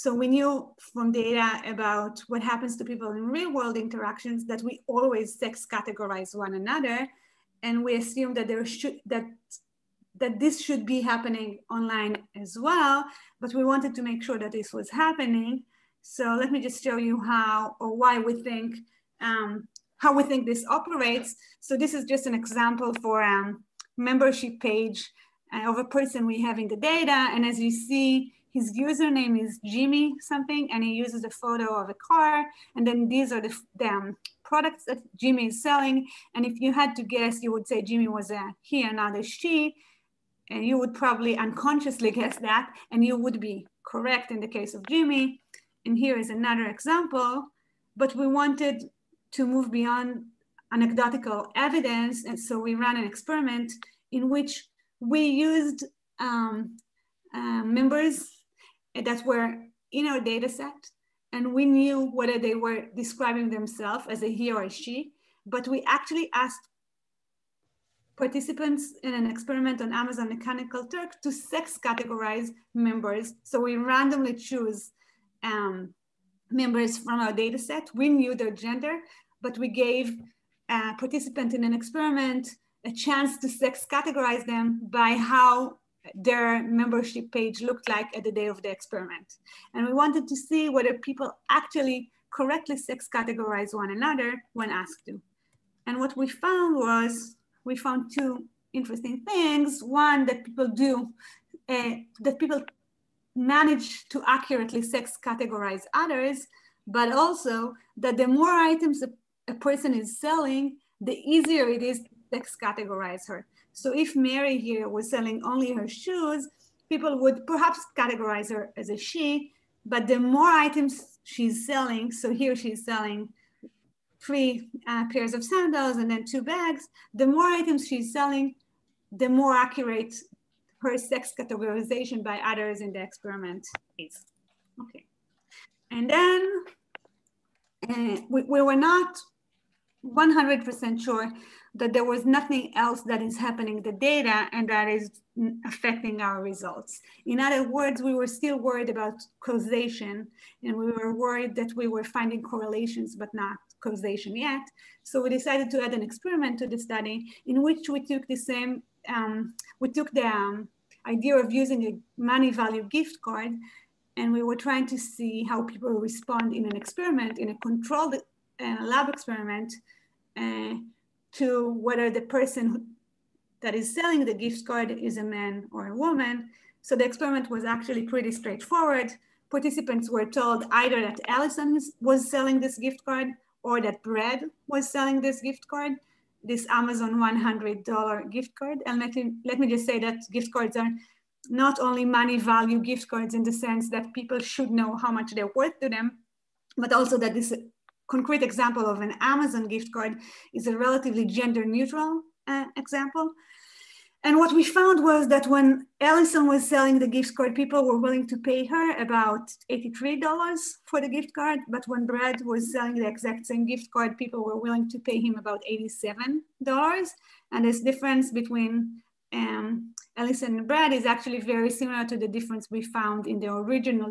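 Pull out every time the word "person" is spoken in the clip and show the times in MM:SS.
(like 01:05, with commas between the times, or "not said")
00:25, 01:49, 02:52.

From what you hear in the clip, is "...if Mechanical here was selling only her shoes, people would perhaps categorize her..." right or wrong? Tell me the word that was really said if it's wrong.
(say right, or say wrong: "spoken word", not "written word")
wrong: "Mary", not "Mechanical".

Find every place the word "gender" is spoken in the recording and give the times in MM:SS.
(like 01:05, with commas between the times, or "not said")
01:18, 03:21.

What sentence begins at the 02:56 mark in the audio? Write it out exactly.
So the experiment was actually pretty straightforward.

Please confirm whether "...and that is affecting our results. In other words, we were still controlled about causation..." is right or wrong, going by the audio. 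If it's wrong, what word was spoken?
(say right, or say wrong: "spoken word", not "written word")
wrong: "worried", not "controlled".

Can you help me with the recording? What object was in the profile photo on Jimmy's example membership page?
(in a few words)
A car.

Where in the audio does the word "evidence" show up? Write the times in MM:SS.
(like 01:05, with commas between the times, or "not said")
00:51.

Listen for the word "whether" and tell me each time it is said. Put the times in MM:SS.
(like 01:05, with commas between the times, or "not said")
01:02, 01:30, 02:51.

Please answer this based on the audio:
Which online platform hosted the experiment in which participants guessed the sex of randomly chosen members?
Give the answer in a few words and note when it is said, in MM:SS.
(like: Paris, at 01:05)
Amazon Mechanical Turk, at 01:09.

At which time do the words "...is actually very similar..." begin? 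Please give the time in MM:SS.
03:40.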